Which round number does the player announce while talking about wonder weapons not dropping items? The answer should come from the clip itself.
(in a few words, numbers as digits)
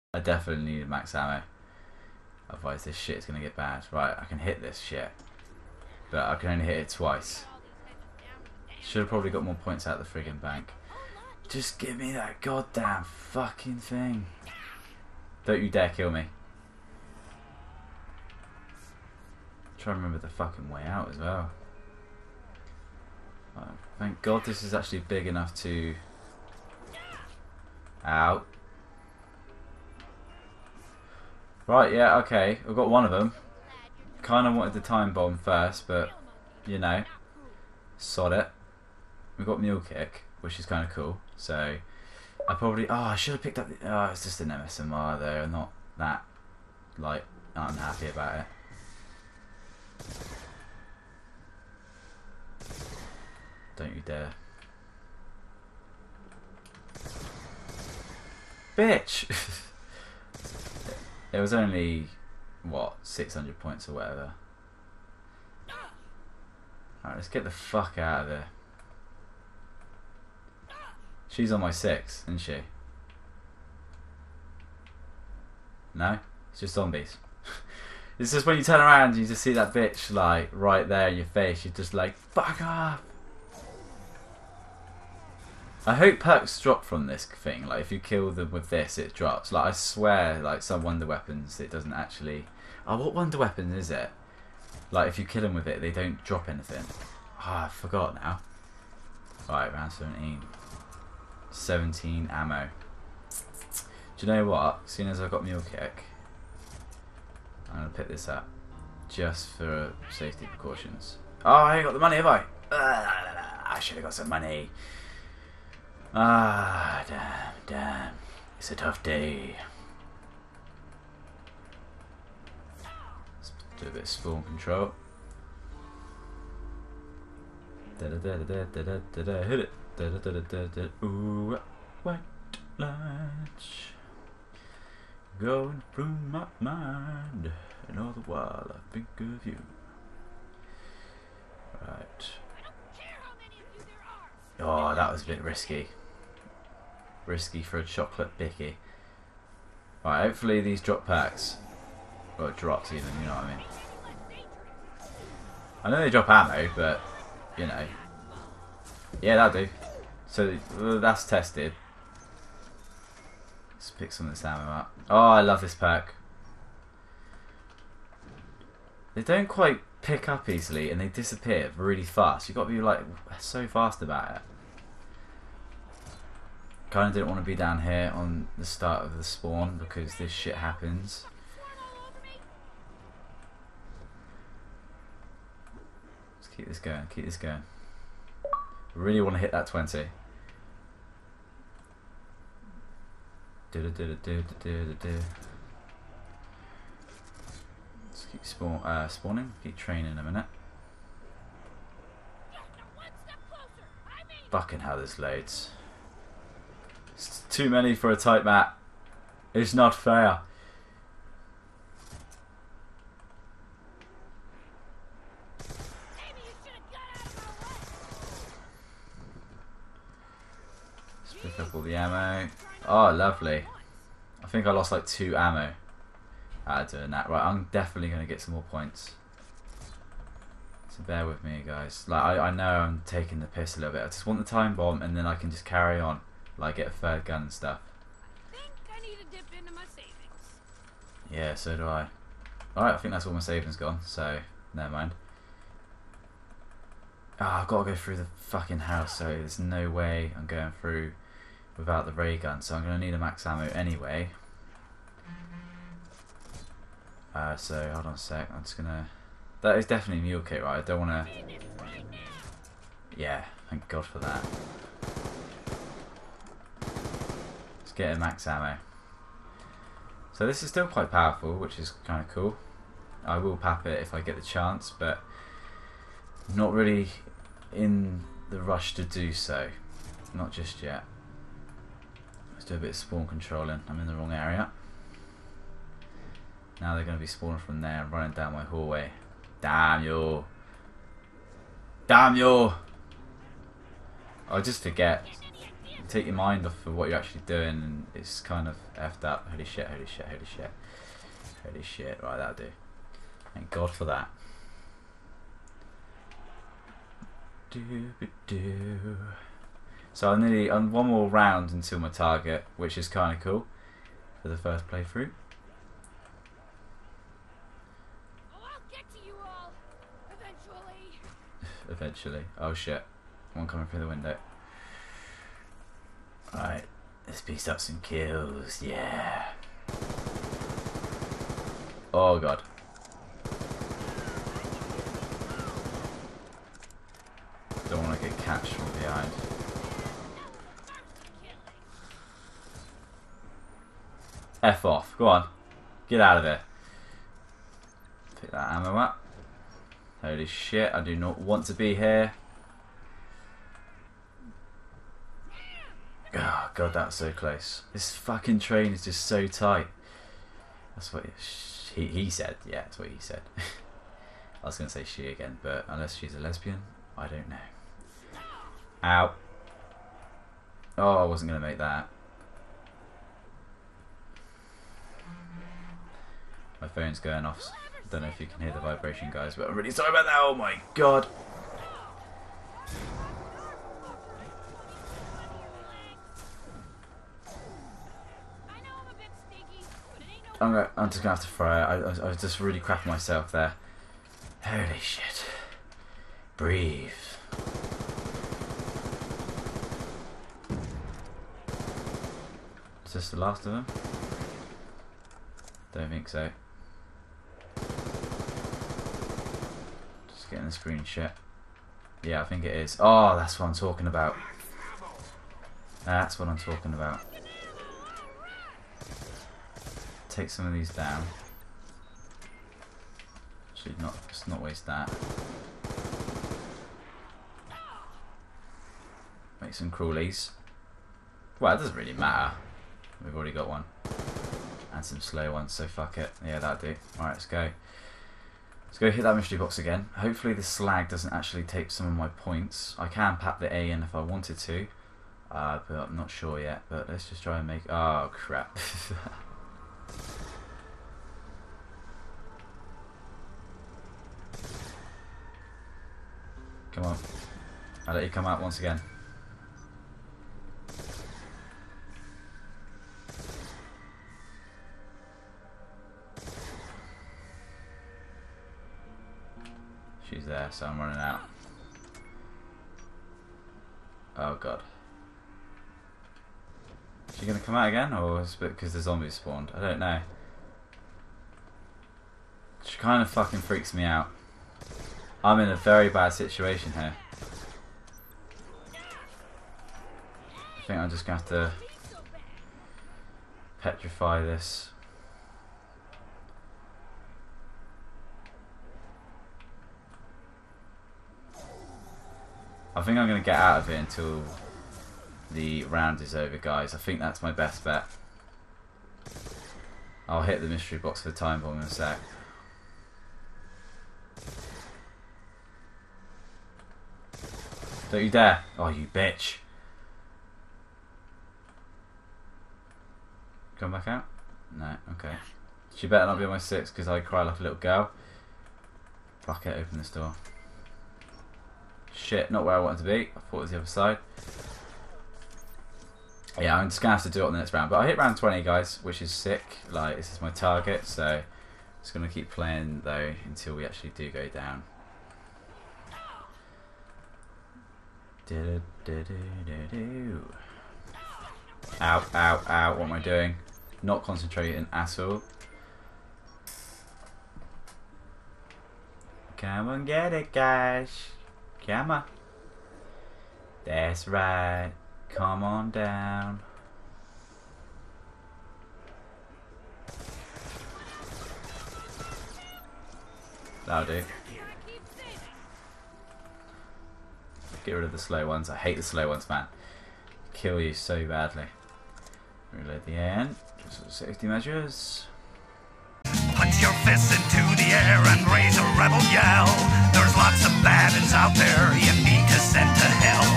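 17.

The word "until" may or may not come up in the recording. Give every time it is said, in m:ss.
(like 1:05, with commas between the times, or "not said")
5:11, 8:23, 9:03.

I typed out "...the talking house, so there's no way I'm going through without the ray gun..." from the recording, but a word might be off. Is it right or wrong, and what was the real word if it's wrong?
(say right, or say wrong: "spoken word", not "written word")
wrong: "fucking", not "talking".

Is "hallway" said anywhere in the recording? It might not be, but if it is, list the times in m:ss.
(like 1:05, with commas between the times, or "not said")
4:48.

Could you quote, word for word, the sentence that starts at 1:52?
Uh, I should have got some money.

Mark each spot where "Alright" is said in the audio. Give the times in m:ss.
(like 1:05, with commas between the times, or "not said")
1:07, 4:02, 7:17.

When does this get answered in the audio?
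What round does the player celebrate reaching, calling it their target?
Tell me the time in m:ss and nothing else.
8:58.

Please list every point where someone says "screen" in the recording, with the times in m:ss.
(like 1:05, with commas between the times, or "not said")
6:50.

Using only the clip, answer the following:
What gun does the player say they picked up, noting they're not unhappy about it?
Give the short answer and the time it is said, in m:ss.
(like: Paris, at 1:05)
MSMC, at 0:44.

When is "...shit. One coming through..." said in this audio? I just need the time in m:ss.
5:22.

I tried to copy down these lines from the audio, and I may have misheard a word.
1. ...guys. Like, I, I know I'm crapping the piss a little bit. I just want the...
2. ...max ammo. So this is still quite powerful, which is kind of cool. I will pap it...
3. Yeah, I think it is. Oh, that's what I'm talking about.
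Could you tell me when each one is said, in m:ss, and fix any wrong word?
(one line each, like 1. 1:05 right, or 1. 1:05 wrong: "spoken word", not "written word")
1. 3:51 wrong: "taking", not "crapping"
2. 4:28 right
3. 6:52 right.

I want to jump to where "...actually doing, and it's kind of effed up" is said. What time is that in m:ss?
4:57.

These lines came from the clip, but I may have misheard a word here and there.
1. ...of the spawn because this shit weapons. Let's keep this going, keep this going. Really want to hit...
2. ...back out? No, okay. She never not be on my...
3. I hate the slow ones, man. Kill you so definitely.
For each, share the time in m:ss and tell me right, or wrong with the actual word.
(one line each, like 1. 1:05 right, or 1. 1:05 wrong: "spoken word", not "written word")
1. 2:59 wrong: "happens", not "weapons"
2. 8:43 wrong: "better", not "never"
3. 9:38 wrong: "badly", not "definitely".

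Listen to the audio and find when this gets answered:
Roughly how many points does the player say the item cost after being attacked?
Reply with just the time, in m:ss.
1:03.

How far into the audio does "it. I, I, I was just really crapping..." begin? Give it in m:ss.
6:31.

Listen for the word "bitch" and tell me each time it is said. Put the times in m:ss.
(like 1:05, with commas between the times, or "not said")
0:58, 1:19, 8:39.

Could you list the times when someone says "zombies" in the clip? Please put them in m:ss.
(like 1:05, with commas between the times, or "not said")
1:16, 7:59.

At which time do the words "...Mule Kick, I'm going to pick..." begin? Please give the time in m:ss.
1:45.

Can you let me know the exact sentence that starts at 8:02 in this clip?
She kind of fucking freaks me out.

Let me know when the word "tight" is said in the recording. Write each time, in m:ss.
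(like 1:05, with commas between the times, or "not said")
3:28, 5:59.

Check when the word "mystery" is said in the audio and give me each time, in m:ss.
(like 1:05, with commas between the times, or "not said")
7:19, 8:30.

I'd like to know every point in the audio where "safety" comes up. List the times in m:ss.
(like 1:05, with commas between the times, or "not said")
1:50, 9:44.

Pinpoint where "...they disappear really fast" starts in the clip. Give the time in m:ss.
2:51.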